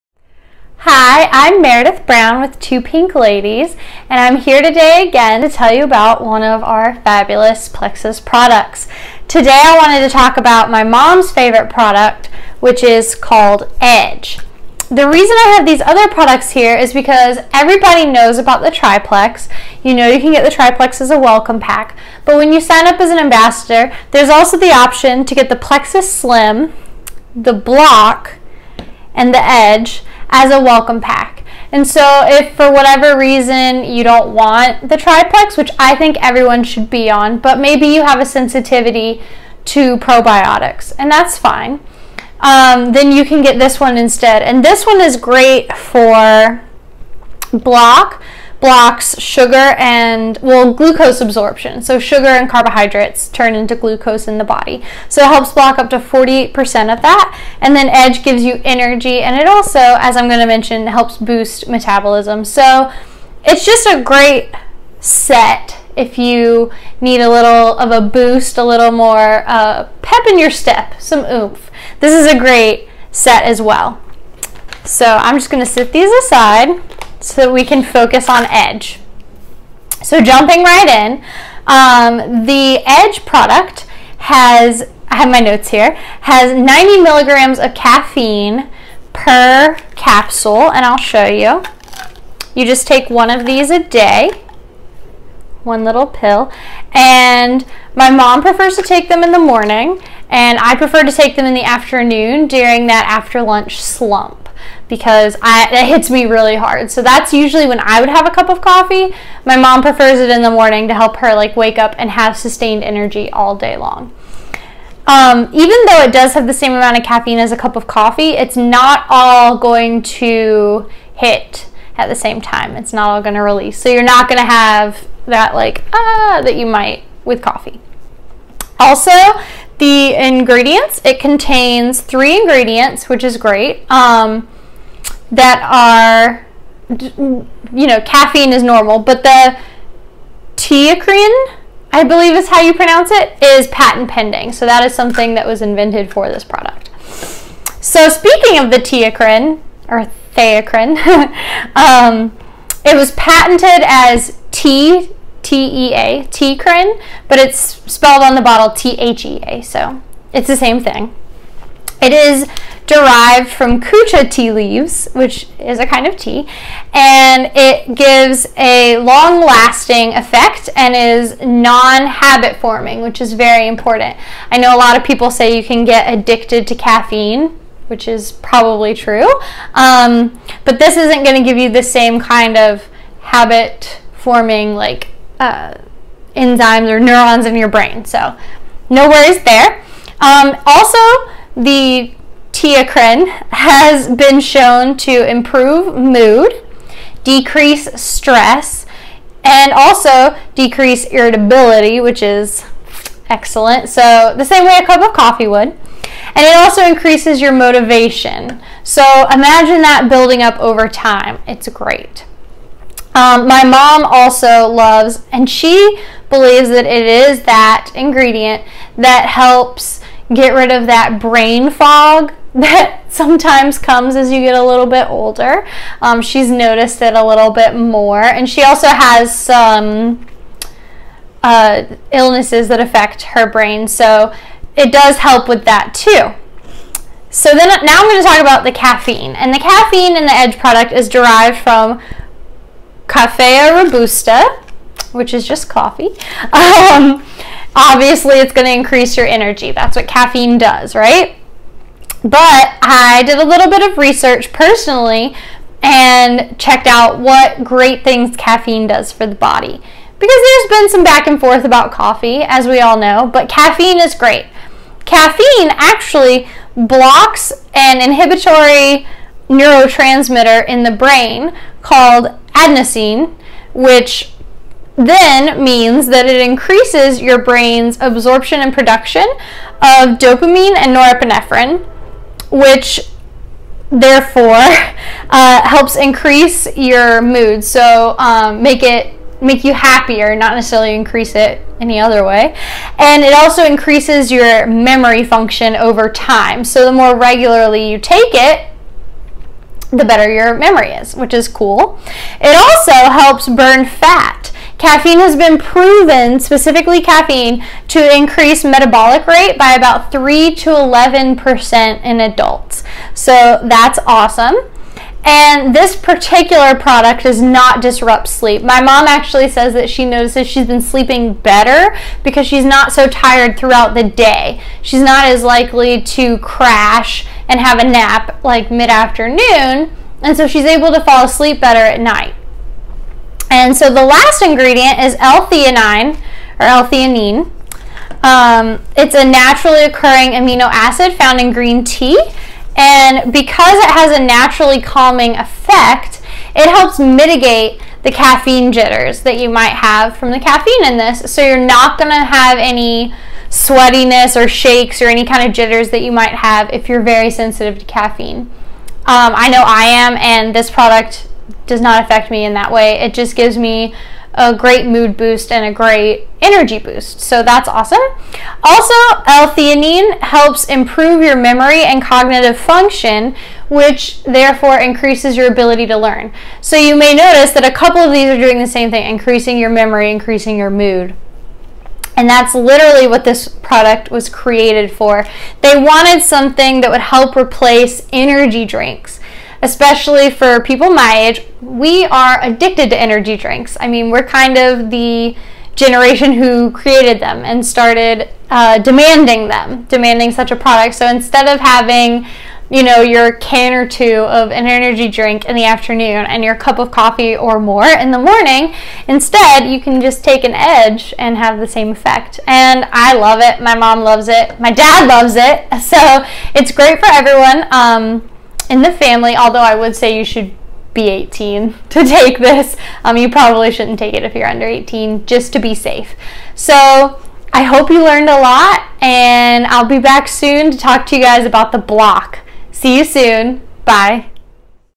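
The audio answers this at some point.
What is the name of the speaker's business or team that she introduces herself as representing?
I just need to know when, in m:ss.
0:02.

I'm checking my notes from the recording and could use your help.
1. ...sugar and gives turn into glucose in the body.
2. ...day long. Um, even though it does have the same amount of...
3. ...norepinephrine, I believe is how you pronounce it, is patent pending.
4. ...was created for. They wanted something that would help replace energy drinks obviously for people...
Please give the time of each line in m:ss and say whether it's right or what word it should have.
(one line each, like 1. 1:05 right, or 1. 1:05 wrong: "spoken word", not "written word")
1. 0:51 wrong: "carbohydrates", not "gives"
2. 1:53 right
3. 2:20 wrong: "teacrine", not "norepinephrine"
4. 6:24 wrong: "especially", not "obviously".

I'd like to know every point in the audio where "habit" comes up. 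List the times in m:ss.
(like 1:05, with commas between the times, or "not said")
2:52, 3:03.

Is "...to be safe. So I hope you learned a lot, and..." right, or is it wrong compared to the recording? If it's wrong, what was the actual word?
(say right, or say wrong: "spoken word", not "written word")
right.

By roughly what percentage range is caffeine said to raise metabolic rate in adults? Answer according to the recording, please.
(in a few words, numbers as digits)
3 to 11%.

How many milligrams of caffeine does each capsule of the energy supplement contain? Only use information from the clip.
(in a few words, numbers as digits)
90 milligrams.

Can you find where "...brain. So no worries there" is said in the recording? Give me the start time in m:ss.
3:07.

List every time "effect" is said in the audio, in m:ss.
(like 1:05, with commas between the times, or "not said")
2:50, 5:45, 6:51.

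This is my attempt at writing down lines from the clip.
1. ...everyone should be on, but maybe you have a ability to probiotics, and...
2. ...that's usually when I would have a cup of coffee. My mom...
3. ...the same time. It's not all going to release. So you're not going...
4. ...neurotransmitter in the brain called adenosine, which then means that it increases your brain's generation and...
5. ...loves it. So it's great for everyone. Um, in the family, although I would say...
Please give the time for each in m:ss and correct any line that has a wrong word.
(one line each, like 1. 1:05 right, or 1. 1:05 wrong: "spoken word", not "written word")
1. 0:36 wrong: "sensitivity", not "ability"
2. 1:47 right
3. 2:02 right
4. 4:29 wrong: "absorption", not "generation"
5. 6:55 right.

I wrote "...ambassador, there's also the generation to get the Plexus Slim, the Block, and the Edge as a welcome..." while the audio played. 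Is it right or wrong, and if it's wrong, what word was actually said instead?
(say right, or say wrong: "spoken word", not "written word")
wrong: "option", not "generation".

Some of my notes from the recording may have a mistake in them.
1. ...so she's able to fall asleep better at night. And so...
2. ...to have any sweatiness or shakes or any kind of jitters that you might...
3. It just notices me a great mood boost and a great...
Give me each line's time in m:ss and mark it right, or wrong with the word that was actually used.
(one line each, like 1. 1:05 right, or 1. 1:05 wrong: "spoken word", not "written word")
1. 5:30 right
2. 5:52 right
3. 6:02 wrong: "gives", not "notices".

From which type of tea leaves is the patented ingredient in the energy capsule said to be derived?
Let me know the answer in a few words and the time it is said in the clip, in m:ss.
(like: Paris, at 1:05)
Kucha tea, at 2:43.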